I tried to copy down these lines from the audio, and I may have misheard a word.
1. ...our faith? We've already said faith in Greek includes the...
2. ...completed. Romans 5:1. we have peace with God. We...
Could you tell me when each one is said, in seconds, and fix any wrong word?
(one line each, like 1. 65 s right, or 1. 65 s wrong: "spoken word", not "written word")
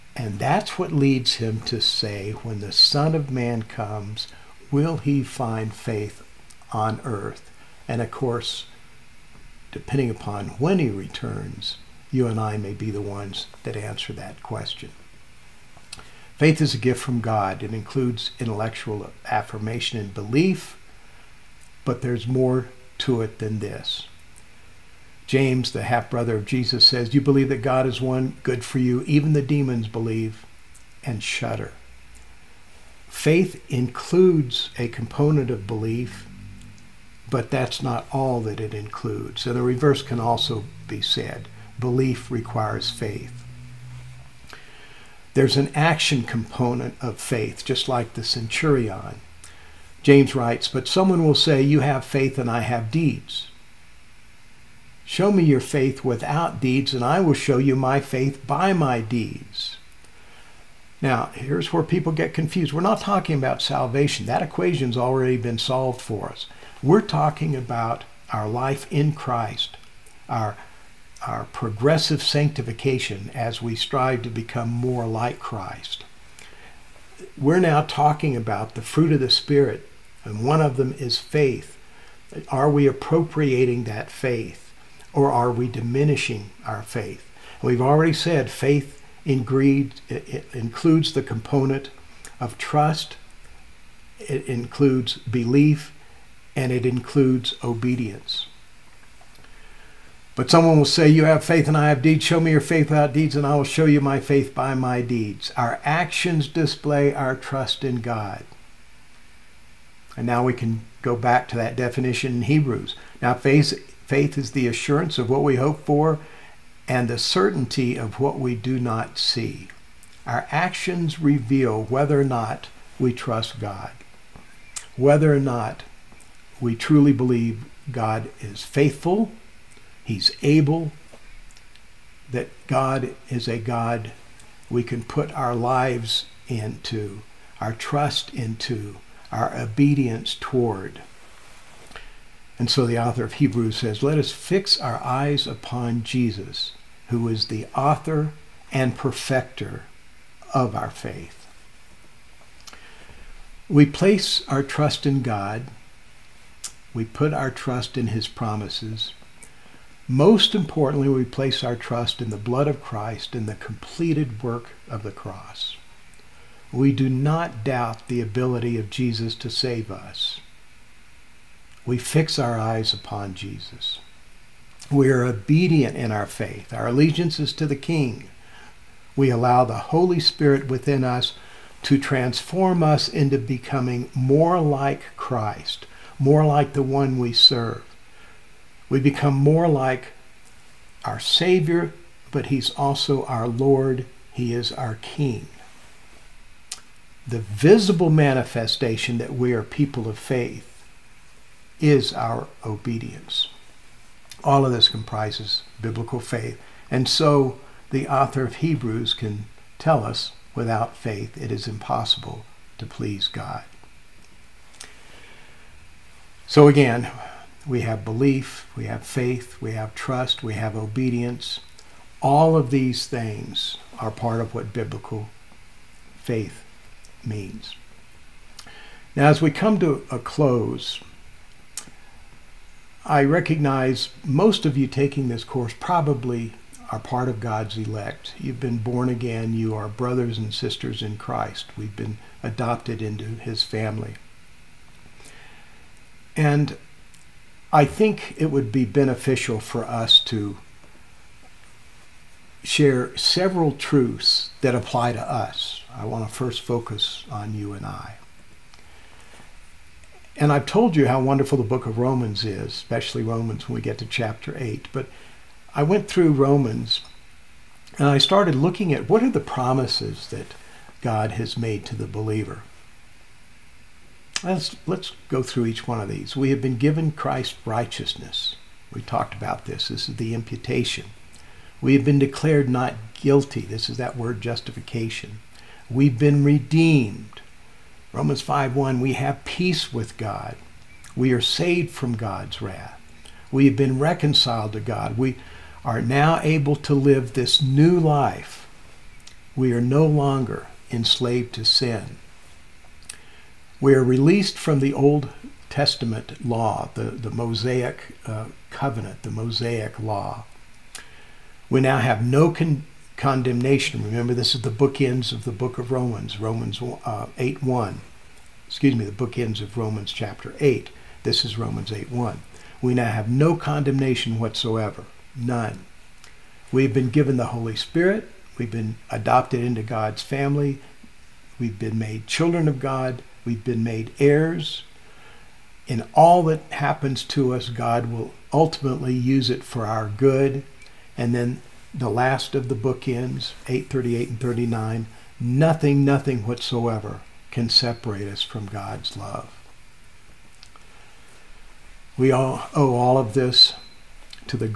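1. 86 s right
2. 286 s wrong: "redeemed", not "completed".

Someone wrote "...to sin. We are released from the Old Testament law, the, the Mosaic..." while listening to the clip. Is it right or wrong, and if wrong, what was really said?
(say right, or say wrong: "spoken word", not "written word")
right.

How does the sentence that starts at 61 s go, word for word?
Now, here's where people get confused.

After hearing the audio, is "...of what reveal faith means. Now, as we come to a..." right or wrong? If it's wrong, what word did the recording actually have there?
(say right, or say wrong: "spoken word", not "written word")
wrong: "biblical", not "reveal".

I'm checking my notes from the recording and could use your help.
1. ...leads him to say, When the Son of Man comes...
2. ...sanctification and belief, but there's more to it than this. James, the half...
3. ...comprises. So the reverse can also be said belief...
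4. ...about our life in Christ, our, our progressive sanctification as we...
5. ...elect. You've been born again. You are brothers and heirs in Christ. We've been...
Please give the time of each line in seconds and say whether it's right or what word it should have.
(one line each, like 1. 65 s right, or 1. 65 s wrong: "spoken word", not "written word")
1. 0 s right
2. 19 s wrong: "affirmation", not "sanctification"
3. 38 s wrong: "includes", not "comprises"
4. 67 s right
5. 237 s wrong: "sisters", not "heirs".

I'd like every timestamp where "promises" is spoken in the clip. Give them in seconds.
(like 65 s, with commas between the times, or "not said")
158 s, 269 s.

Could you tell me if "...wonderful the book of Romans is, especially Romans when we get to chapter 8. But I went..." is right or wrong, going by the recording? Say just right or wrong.
right.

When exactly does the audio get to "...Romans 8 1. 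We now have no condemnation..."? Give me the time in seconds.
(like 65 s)
321 s.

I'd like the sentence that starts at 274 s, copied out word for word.
Let's, let's go through each one of these.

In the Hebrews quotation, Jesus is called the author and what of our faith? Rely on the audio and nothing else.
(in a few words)
perfecter.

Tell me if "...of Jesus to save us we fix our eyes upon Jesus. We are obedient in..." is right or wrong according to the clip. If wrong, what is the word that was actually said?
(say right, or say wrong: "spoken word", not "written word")
right.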